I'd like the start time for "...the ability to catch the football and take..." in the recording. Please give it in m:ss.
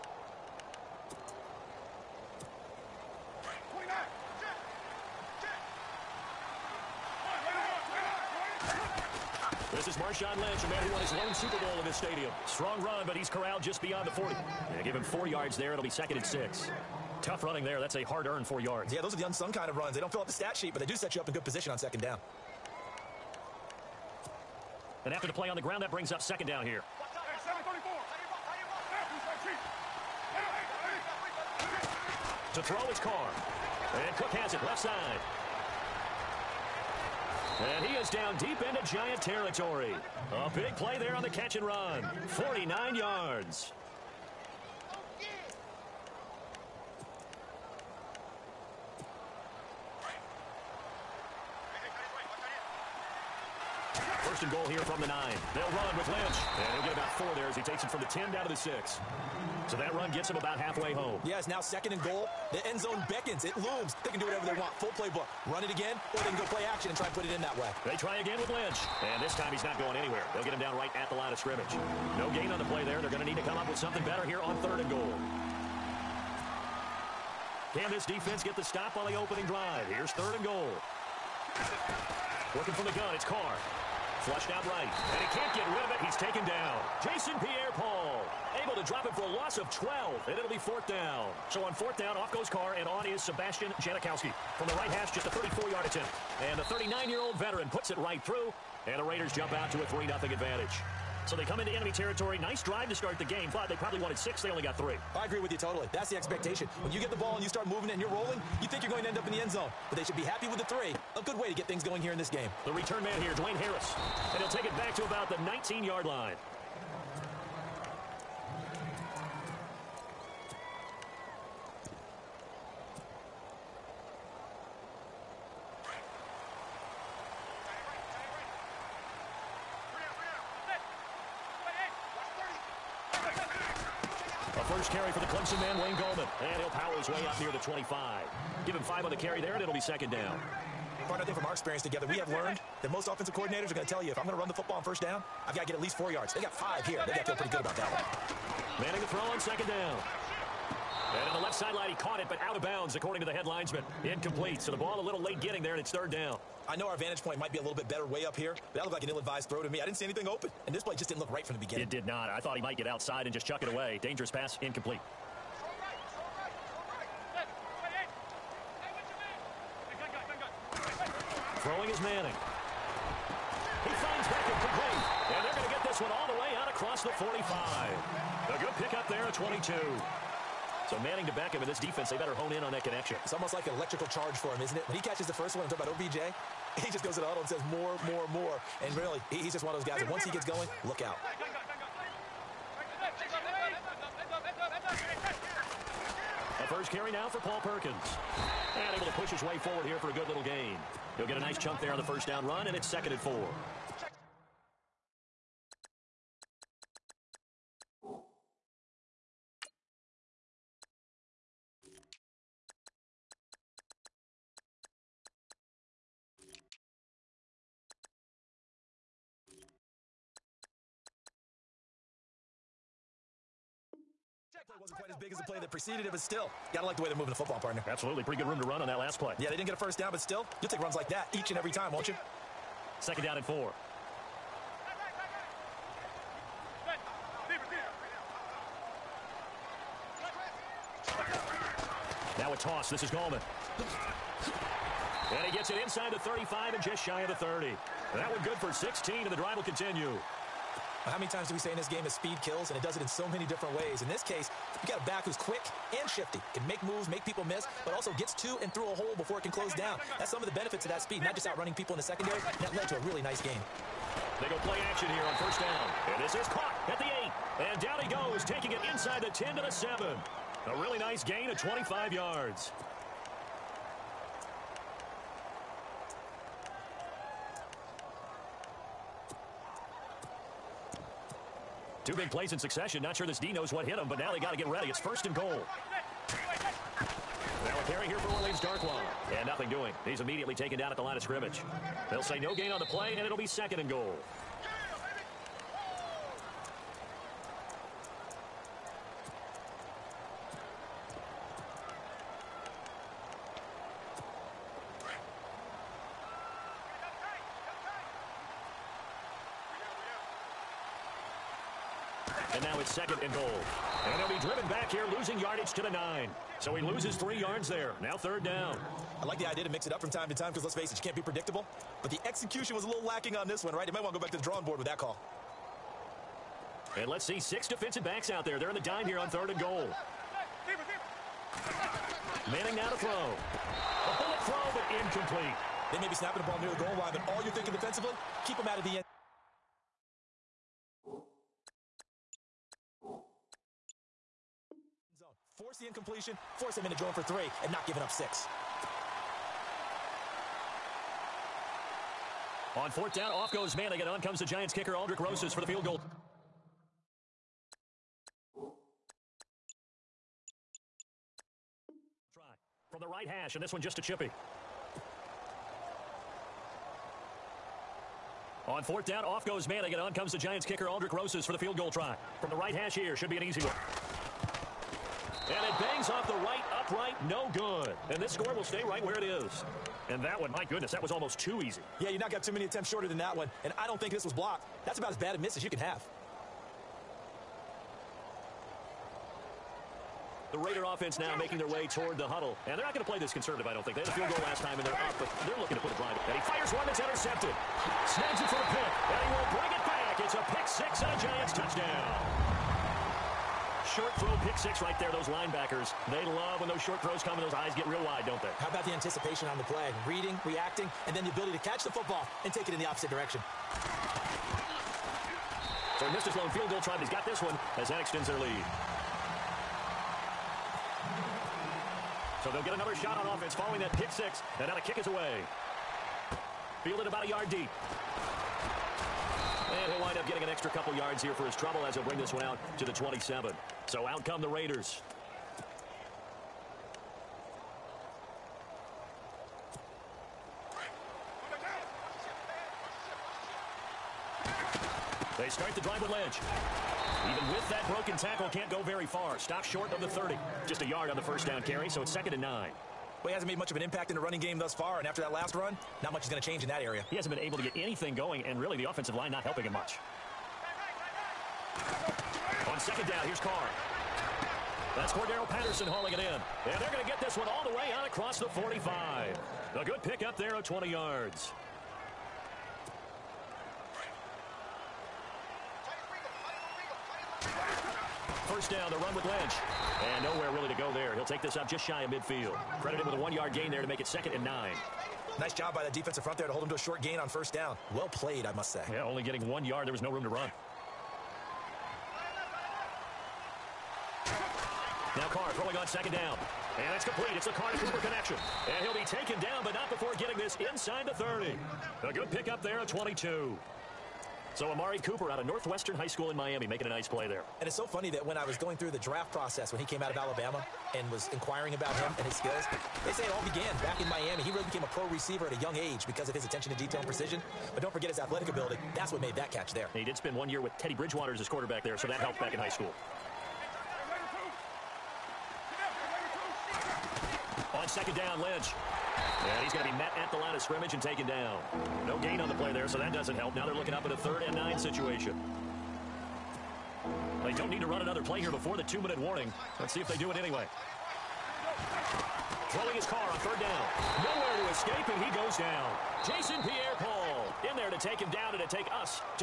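6:51.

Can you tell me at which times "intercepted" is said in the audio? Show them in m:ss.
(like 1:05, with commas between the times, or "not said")
6:37.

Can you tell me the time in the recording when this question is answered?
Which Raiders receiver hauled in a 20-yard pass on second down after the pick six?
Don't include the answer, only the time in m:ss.
7:45.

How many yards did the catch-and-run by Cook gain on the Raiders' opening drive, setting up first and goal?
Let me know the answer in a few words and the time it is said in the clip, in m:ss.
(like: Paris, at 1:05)
49, at 0:42.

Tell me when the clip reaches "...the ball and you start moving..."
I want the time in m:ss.
1:47.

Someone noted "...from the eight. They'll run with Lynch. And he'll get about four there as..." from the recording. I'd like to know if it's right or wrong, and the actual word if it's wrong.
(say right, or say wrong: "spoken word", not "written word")
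wrong: "nine", not "eight".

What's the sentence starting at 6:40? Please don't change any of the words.
It's a pick six and a Giants touchdown short throw pick six right there.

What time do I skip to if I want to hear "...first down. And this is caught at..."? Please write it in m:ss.
4:25.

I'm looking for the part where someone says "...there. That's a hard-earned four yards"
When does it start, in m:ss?
0:17.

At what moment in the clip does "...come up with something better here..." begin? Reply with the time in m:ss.
1:13.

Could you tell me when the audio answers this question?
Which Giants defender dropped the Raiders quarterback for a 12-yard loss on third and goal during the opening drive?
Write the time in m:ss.
1:26.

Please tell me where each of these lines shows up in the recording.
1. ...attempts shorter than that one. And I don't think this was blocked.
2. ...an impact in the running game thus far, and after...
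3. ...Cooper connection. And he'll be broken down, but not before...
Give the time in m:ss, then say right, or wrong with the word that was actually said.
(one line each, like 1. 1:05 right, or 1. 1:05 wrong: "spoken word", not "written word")
1. 6:22 right
2. 7:33 right
3. 8:17 wrong: "taken", not "broken".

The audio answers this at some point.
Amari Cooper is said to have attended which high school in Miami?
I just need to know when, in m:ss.
8:25.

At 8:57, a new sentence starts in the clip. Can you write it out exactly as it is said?
They don't need to run another play here before the two-minute warning.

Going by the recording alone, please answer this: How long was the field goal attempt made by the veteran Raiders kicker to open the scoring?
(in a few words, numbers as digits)
34 yards.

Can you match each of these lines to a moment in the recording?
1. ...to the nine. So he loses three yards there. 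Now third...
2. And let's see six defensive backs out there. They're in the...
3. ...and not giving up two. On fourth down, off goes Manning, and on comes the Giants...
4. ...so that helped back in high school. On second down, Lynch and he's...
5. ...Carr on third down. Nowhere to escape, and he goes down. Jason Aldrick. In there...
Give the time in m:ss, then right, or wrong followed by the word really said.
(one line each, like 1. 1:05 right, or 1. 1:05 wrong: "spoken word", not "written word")
1. 5:15 right
2. 5:26 right
3. 5:47 wrong: "six", not "two"
4. 8:41 right
5. 9:03 wrong: "Pierre", not "Aldrick".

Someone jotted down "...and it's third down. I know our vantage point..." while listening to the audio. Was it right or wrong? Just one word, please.
right.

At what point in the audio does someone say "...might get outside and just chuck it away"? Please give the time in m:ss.
2:42.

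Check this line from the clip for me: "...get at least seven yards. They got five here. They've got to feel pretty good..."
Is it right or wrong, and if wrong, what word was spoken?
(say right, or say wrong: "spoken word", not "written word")
wrong: "four", not "seven".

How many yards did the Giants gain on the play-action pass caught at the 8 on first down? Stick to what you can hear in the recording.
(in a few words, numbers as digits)
25.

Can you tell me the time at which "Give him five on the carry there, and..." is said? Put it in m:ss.
2:18.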